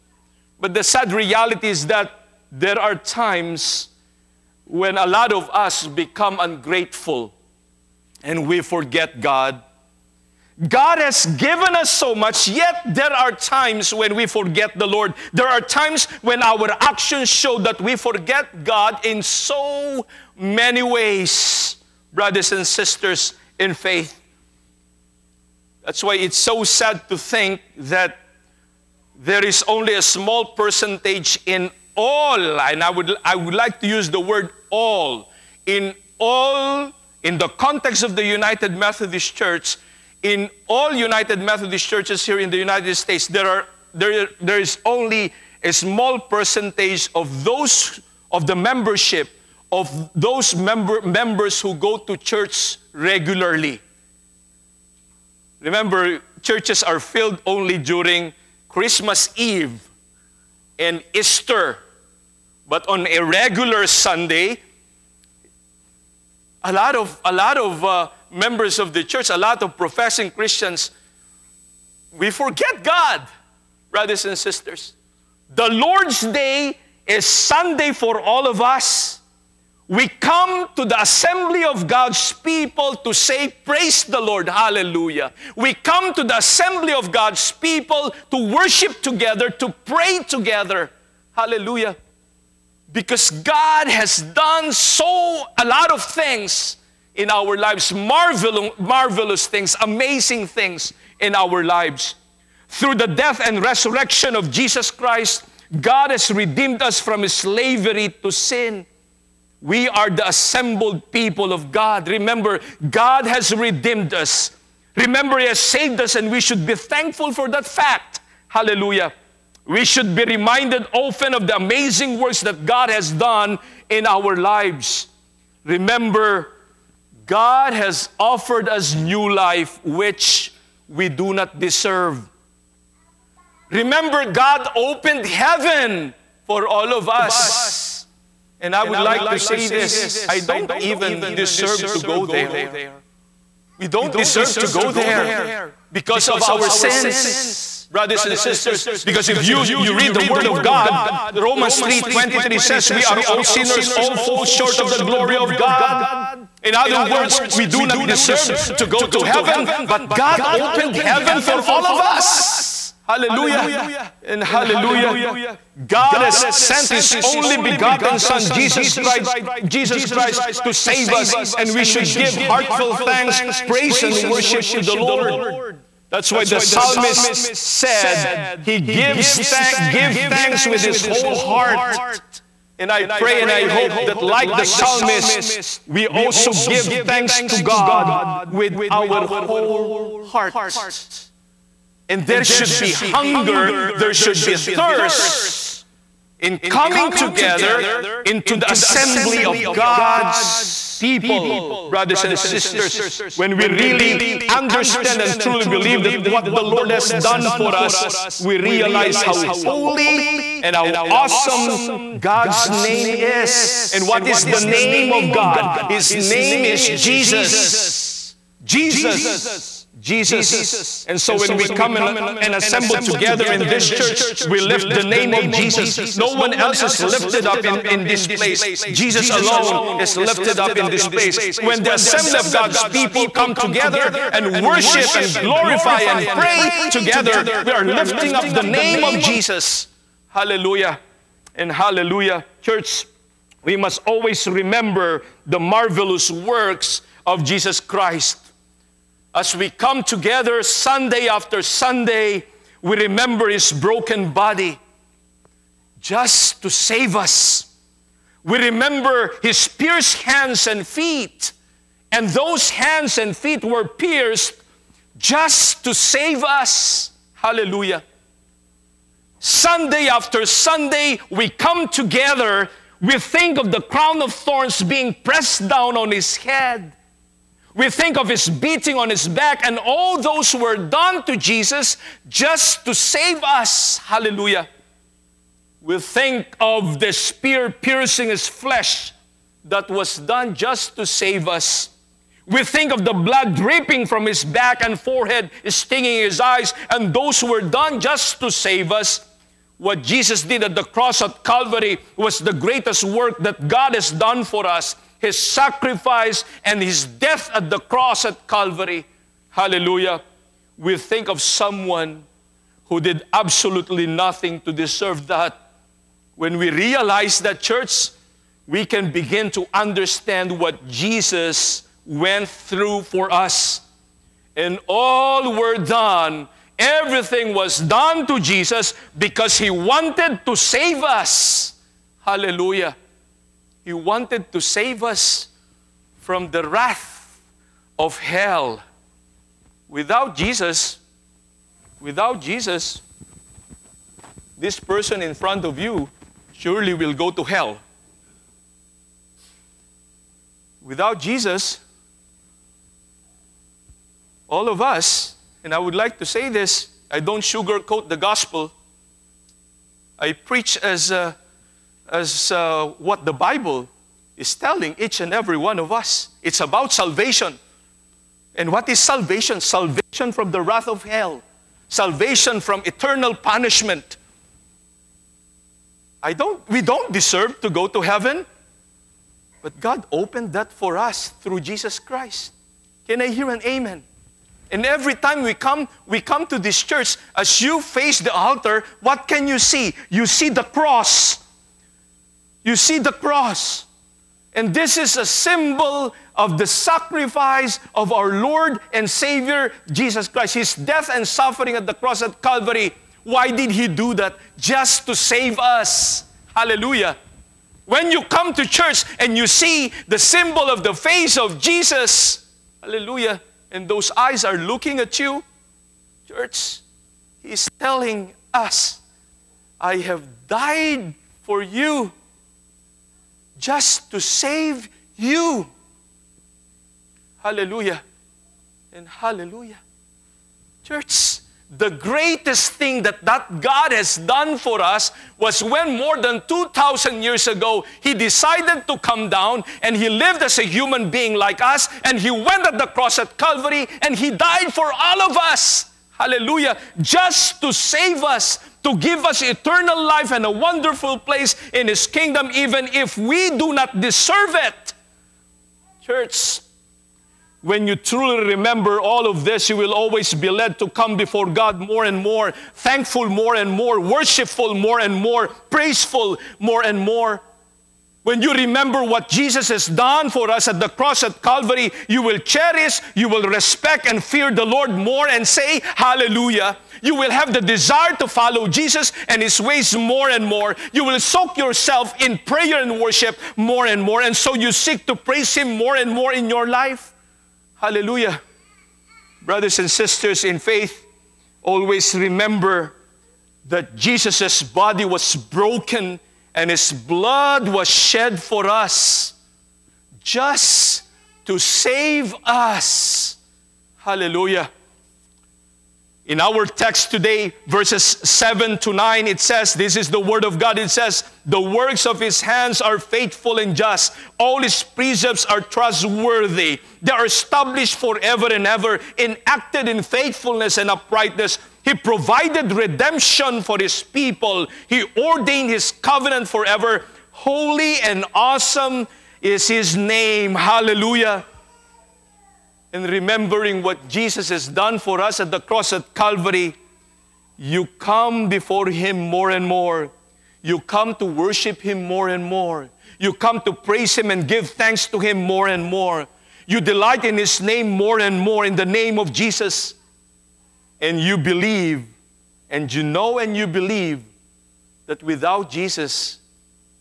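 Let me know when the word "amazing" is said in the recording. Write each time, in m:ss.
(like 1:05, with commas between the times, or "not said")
1:39, 2:01.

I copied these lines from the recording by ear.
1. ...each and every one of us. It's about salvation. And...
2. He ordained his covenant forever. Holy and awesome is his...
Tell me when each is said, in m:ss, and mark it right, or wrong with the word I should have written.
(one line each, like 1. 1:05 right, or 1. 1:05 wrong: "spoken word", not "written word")
1. 6:04 right
2. 8:44 right.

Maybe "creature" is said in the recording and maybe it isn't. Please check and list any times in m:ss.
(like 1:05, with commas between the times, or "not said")
not said.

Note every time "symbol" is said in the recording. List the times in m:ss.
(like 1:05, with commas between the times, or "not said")
6:35, 6:50.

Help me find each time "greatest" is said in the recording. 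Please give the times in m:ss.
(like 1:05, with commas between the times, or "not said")
5:02, 7:11.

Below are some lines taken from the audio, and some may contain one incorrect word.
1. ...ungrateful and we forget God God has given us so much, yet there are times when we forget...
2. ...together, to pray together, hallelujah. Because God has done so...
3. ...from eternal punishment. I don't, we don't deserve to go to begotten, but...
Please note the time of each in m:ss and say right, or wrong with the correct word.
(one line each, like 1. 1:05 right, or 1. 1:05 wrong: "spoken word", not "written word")
1. 0:06 right
2. 1:28 right
3. 6:12 wrong: "heaven", not "begotten".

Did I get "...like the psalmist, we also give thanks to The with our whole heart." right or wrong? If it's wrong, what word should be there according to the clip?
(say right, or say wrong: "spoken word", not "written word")
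wrong: "God", not "The".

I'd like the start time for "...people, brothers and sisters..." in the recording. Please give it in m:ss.
3:20.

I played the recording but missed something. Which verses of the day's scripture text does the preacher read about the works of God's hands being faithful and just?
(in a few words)
verses 7 to 9.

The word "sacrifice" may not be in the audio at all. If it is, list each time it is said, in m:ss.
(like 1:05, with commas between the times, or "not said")
5:05, 6:36.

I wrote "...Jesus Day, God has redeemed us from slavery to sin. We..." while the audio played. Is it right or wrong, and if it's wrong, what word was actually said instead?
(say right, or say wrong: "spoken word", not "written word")
wrong: "Christ", not "Day".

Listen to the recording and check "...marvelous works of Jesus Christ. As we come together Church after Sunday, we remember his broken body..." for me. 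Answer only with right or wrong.
wrong.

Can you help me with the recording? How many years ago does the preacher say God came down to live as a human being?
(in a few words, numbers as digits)
more than 2,000.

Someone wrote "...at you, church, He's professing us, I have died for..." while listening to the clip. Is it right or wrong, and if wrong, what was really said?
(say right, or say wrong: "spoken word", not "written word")
wrong: "telling", not "professing".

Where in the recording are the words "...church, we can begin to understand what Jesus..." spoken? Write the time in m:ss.
5:17.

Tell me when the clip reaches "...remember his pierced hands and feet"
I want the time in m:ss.
4:18.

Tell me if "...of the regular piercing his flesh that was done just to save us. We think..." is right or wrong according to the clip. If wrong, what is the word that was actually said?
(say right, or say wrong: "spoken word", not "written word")
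wrong: "spear", not "regular".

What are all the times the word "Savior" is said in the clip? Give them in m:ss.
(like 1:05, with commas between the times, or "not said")
6:39.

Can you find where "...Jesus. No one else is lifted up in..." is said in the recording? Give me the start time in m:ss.
3:45.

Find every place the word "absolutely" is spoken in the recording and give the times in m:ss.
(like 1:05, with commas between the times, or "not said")
5:13.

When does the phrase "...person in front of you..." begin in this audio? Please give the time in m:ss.
5:44.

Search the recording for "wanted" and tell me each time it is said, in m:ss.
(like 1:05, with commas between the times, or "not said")
5:29, 5:33.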